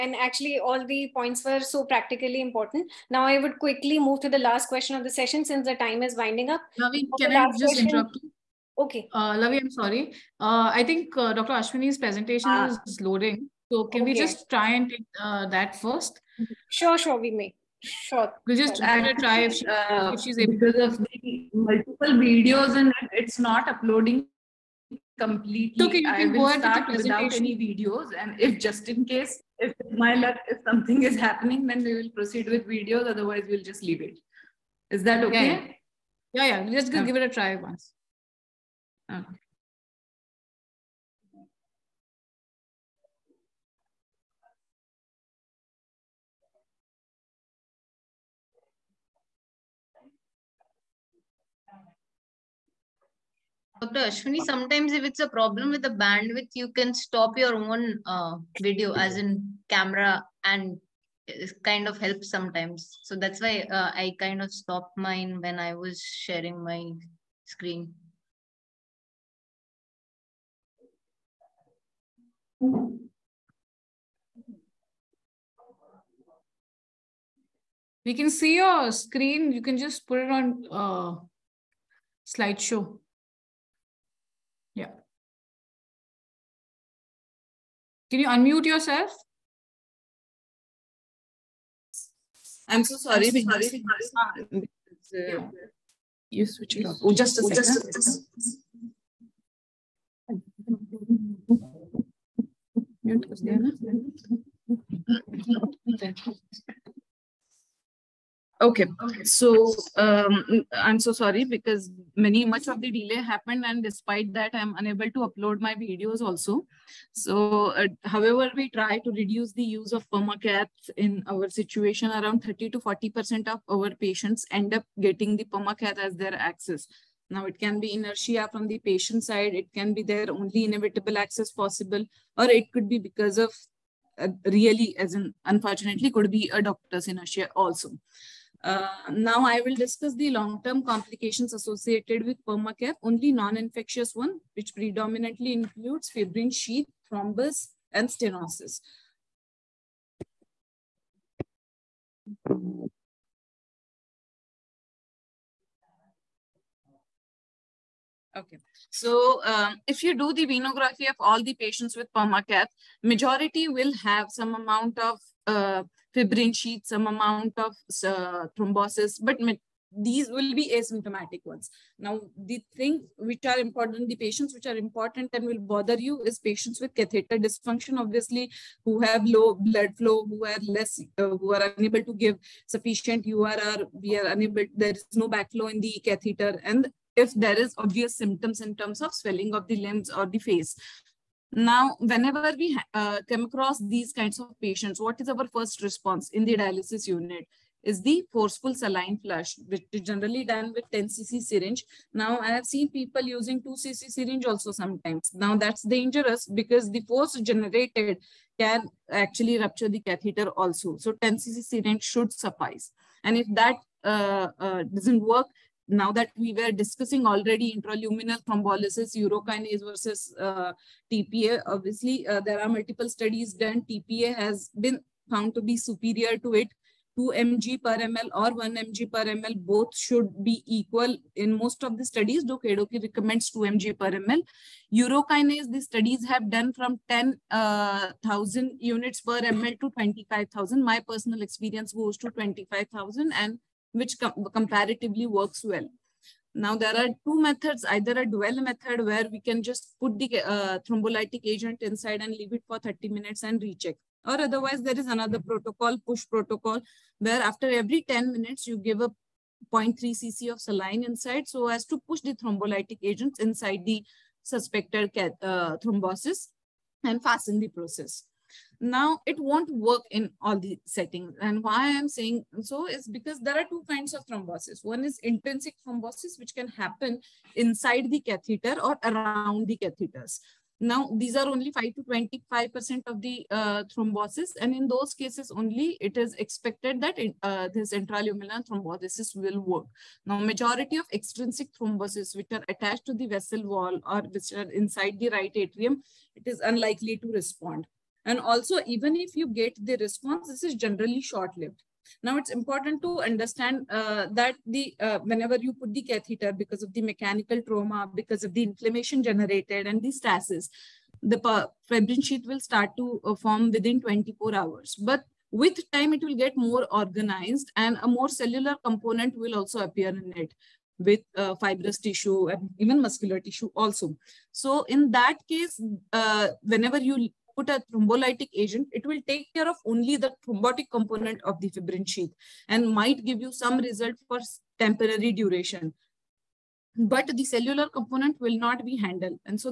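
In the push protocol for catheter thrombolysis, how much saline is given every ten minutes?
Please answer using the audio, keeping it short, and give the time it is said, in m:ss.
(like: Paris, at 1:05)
0.3 cc, at 4:19.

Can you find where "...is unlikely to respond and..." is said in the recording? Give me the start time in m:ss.
4:56.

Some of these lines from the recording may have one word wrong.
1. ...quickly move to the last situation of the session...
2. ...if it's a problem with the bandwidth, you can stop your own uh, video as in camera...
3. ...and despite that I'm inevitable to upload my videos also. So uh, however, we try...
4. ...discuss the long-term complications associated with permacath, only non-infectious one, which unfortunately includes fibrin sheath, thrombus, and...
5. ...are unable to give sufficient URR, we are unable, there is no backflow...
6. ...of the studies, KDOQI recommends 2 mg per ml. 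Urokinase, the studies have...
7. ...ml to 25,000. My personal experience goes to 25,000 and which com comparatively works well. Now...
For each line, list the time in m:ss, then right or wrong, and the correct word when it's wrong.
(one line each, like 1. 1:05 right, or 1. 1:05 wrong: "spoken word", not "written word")
1. 0:03 wrong: "question", not "situation"
2. 0:54 right
3. 1:53 wrong: "unable", not "inevitable"
4. 2:19 wrong: "predominantly", not "unfortunately"
5. 3:01 right
6. 3:51 right
7. 3:59 right.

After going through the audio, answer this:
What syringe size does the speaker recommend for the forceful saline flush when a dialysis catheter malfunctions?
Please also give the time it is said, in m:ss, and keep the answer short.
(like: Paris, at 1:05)
10 cc, at 3:31.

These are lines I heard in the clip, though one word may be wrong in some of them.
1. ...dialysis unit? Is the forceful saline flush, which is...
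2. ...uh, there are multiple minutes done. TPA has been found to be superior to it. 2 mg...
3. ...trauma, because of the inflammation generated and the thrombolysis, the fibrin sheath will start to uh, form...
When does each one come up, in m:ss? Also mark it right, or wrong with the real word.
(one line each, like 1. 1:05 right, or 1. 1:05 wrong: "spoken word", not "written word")
1. 3:16 right
2. 3:42 wrong: "studies", not "minutes"
3. 5:07 wrong: "stasis", not "thrombolysis".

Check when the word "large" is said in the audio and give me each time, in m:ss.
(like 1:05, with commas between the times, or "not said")
not said.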